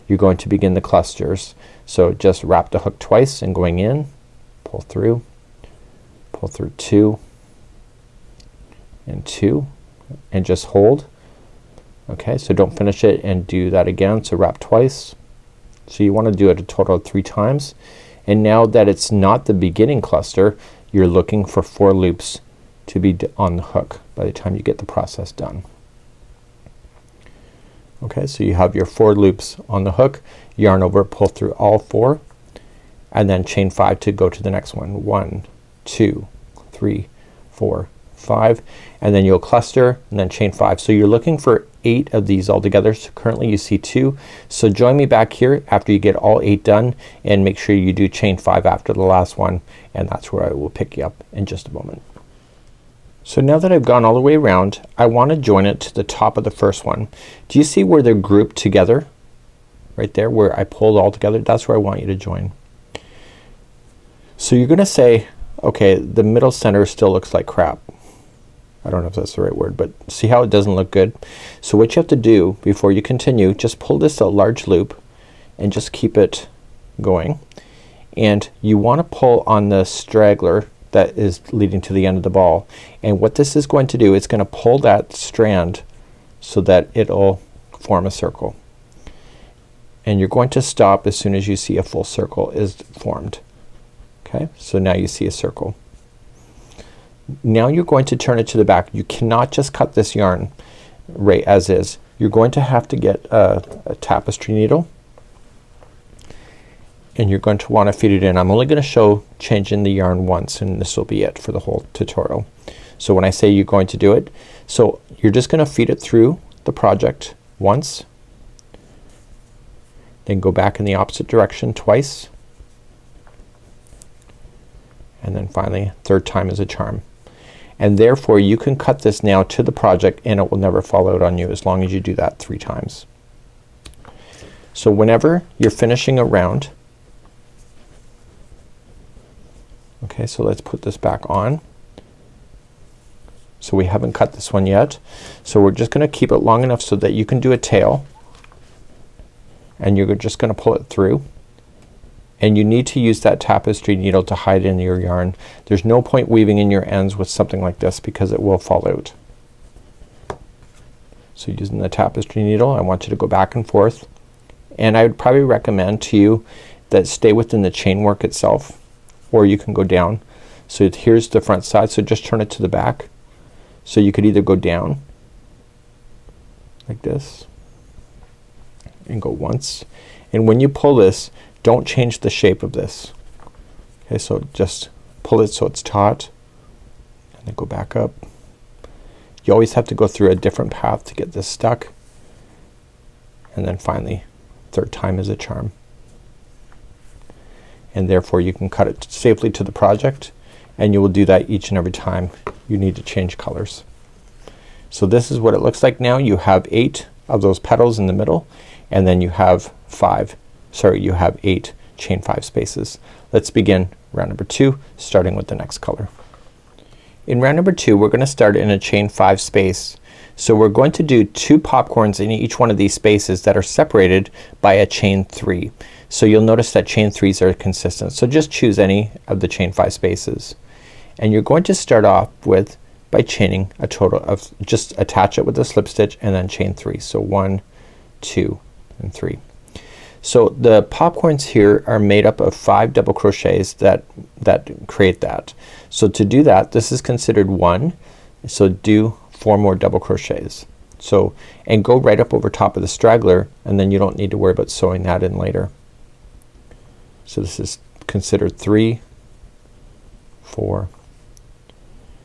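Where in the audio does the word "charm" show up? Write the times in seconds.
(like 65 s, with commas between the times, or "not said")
126 s, 195 s.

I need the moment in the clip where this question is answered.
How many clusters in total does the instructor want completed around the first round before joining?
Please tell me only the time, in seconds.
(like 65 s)
41 s.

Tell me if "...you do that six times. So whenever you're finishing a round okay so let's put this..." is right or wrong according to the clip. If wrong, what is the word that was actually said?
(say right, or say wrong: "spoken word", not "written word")
wrong: "three", not "six".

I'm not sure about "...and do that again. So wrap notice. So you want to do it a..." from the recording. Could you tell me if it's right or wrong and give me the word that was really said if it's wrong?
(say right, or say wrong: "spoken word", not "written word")
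wrong: "twice", not "notice".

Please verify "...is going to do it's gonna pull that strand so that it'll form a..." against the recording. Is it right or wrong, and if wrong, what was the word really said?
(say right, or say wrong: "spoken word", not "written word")
right.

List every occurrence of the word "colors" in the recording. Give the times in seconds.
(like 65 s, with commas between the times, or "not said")
203 s, 215 s.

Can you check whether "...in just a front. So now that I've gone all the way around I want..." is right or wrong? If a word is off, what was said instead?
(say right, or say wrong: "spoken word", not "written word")
wrong: "moment", not "front".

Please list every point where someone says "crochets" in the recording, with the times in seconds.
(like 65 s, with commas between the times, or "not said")
243 s, 250 s.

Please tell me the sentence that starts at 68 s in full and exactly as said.
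I don't know if that's the right word but see how it doesn't look good?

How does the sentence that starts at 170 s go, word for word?
So here's the front side so just turn it to the back.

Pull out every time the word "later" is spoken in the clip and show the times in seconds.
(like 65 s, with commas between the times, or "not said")
255 s.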